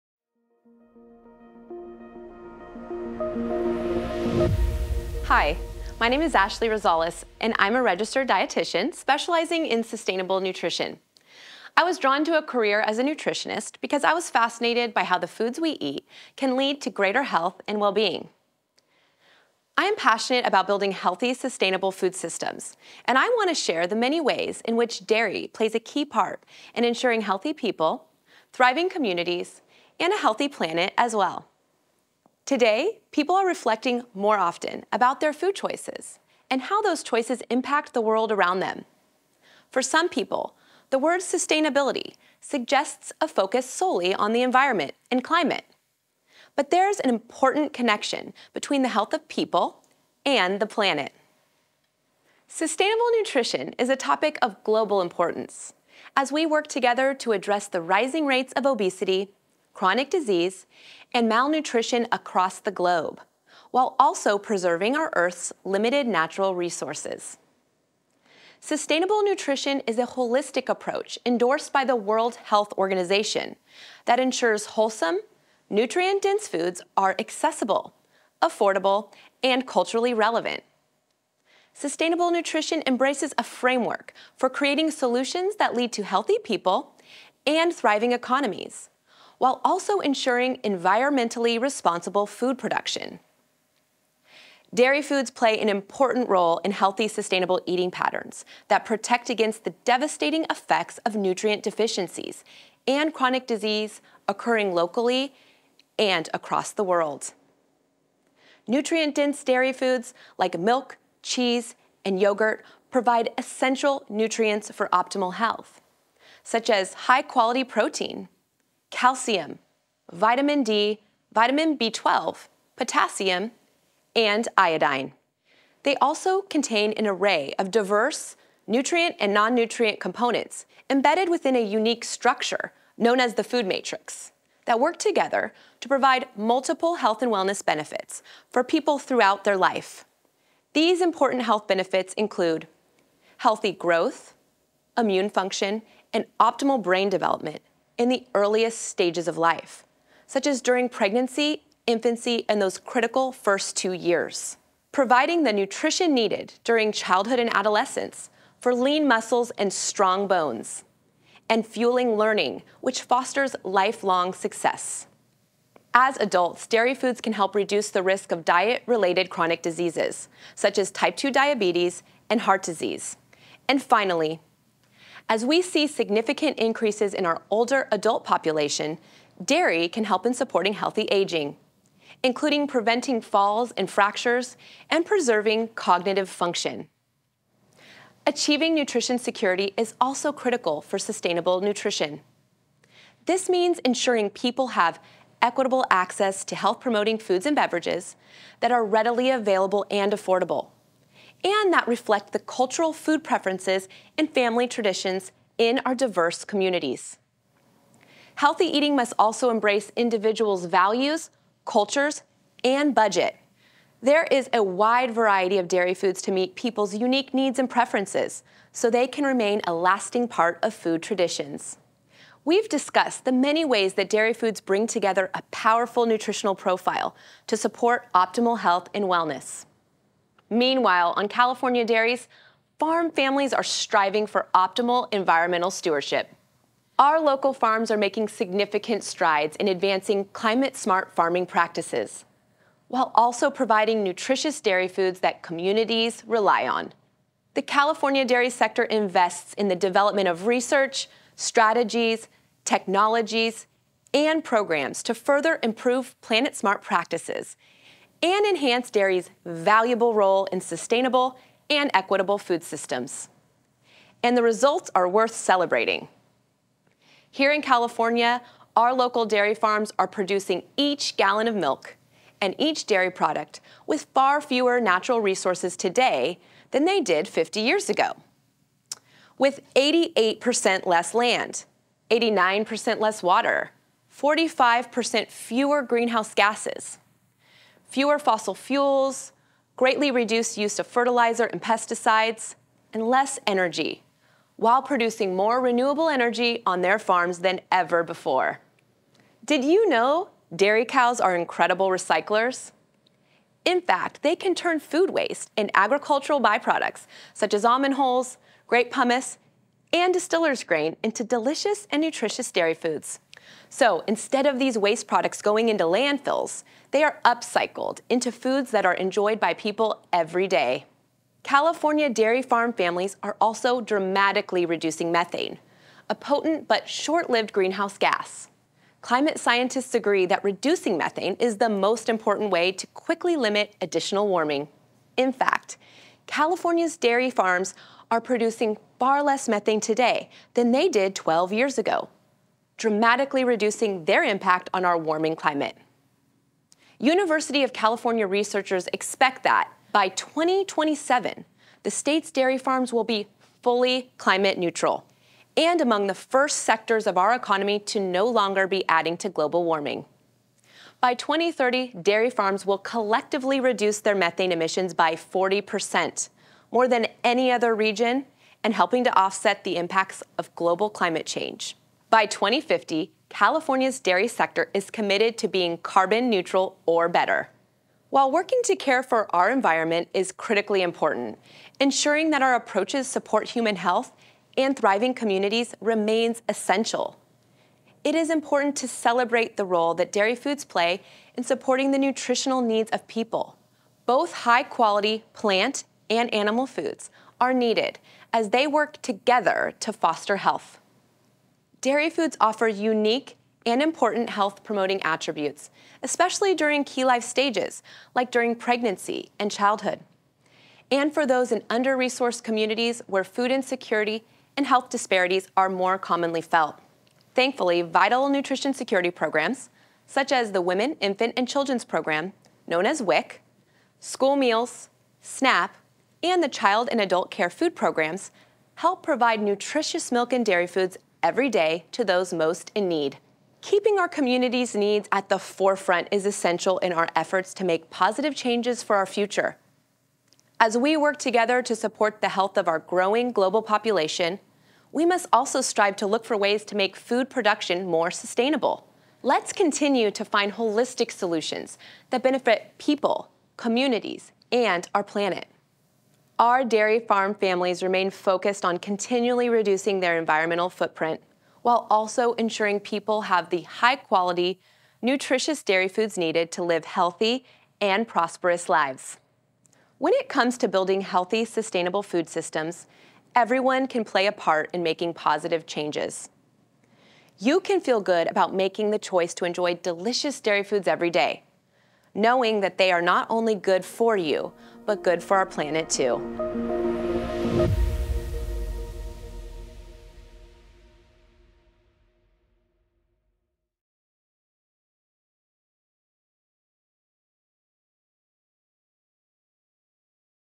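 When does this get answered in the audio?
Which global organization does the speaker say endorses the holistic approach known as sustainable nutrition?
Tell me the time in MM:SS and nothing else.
01:11.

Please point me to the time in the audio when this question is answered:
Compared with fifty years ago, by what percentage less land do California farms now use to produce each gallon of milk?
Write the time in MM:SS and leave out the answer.
04:39.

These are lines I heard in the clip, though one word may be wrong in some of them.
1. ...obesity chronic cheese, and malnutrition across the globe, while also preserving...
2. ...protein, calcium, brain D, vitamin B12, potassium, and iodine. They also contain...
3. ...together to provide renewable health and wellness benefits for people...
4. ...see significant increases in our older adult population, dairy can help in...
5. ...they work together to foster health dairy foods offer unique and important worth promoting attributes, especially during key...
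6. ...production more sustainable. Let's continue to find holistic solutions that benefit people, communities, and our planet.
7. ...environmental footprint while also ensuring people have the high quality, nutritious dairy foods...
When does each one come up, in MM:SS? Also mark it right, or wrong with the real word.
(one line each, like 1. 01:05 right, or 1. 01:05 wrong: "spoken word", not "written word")
1. 00:58 wrong: "disease", not "cheese"
2. 01:57 wrong: "vitamin", not "brain"
3. 02:14 wrong: "multiple", not "renewable"
4. 02:55 right
5. 06:38 wrong: "health", not "worth"
6. 07:27 right
7. 07:40 right.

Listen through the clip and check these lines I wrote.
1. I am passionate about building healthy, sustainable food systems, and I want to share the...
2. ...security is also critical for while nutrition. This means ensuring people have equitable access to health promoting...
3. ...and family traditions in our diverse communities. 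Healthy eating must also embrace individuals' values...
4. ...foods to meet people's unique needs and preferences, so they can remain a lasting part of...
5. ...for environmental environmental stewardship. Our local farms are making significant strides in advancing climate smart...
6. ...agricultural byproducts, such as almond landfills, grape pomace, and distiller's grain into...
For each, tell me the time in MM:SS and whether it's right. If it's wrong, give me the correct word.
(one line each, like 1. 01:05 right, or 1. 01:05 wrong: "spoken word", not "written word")
1. 00:19 right
2. 03:09 wrong: "sustainable", not "while"
3. 03:24 right
4. 03:35 right
5. 03:54 wrong: "optimal", not "environmental"
6. 05:05 wrong: "hulls", not "landfills".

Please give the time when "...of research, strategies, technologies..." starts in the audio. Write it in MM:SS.
04:10.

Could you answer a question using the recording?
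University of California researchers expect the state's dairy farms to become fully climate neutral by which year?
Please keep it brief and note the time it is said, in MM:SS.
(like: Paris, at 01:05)
2027, at 05:50.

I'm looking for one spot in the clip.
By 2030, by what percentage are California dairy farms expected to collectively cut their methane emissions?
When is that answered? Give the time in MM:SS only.
06:05.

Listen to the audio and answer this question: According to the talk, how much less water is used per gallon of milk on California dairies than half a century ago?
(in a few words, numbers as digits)
89%.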